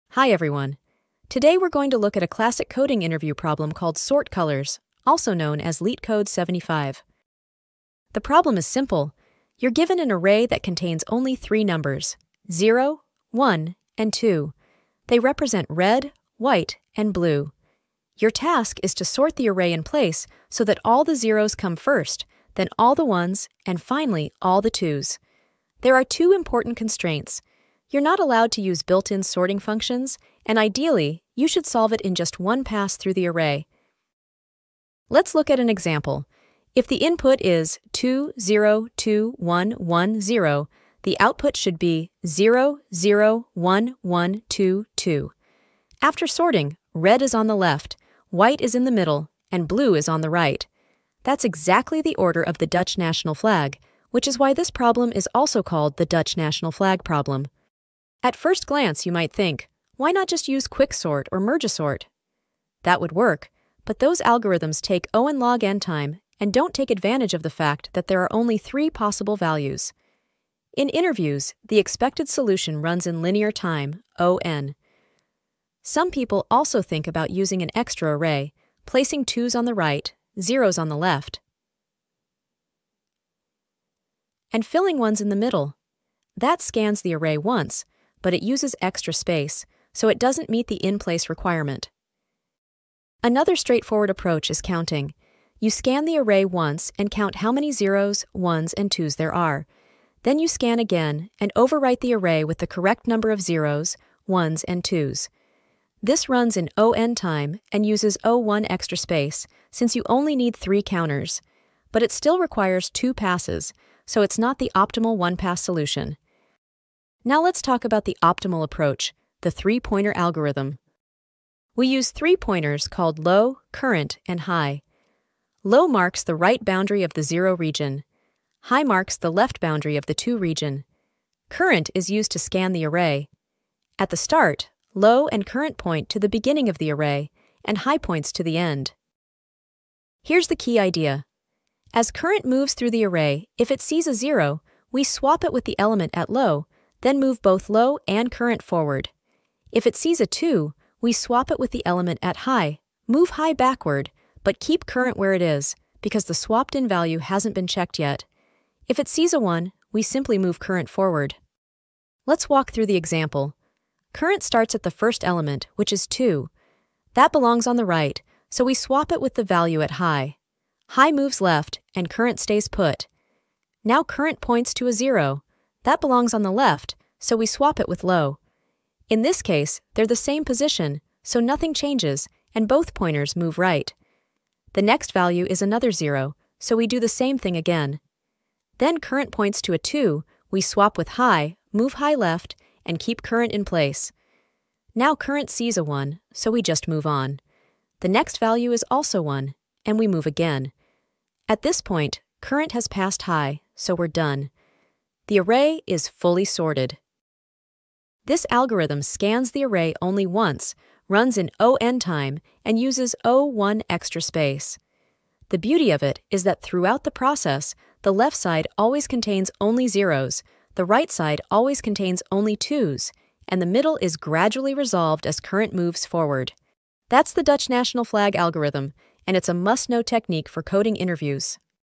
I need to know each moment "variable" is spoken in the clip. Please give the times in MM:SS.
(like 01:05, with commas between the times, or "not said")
not said.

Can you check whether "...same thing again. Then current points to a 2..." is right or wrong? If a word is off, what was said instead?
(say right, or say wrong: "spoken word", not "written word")
right.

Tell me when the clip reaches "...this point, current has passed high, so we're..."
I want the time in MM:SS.
03:21.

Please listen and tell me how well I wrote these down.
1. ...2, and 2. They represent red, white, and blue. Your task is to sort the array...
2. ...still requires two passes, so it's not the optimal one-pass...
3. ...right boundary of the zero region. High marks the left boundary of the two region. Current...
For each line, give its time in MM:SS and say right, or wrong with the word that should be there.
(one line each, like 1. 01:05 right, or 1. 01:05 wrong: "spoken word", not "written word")
1. 00:13 wrong: "1", not "2"
2. 01:52 right
3. 02:06 right.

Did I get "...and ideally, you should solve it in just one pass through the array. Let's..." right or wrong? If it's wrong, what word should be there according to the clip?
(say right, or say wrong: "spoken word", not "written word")
right.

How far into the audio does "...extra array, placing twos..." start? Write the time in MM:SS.
01:17.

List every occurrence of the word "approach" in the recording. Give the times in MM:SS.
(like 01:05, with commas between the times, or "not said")
01:34, 01:58.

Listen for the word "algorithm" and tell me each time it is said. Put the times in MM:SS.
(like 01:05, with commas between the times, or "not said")
01:04, 02:00, 03:28, 03:48.